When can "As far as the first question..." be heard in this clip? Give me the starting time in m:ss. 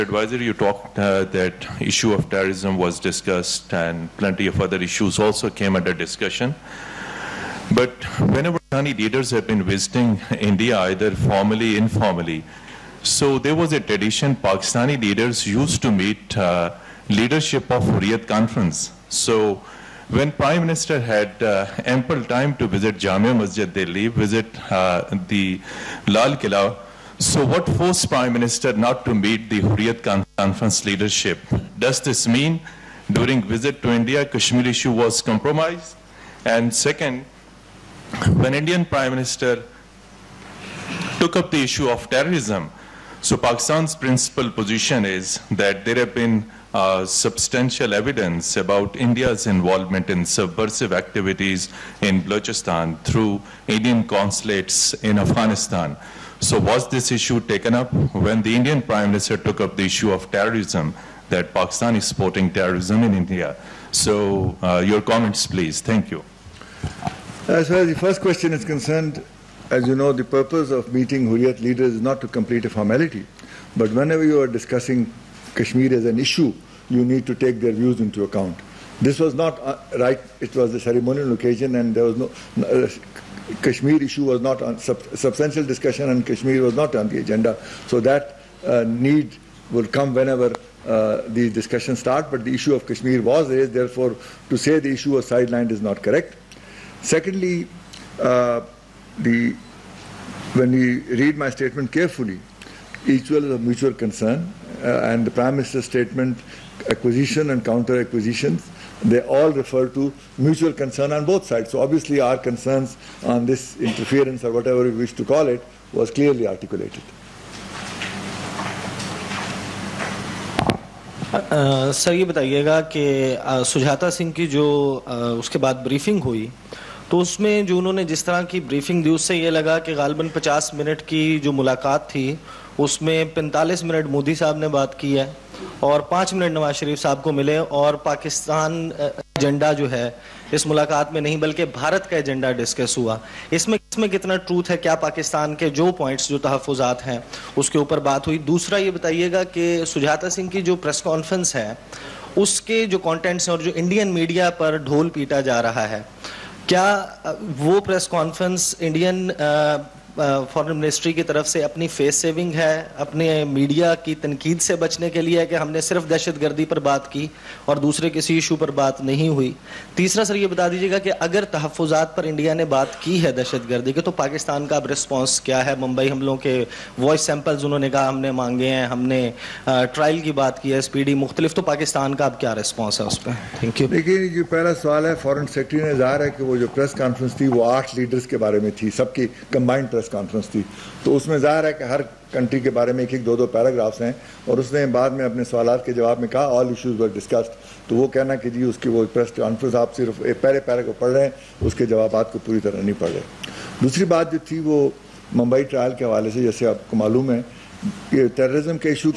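1:07.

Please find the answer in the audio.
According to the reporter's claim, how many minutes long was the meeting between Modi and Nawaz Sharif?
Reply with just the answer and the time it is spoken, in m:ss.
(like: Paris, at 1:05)
50, at 2:10.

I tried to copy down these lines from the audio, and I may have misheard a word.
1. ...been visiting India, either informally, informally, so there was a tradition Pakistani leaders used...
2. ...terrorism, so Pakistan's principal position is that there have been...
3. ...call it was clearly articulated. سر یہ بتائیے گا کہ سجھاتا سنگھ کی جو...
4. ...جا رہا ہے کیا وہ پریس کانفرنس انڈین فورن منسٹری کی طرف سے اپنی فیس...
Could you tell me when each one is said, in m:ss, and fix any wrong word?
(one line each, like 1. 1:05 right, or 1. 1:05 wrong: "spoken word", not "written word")
1. 0:09 wrong: "formally", not "informally"
2. 0:42 right
3. 1:55 right
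4. 2:35 right.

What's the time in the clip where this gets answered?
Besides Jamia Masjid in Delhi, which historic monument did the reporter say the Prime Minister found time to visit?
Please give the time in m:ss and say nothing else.
0:26.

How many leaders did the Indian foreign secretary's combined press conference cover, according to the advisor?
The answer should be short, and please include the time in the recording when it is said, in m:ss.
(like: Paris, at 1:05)
8, at 3:07.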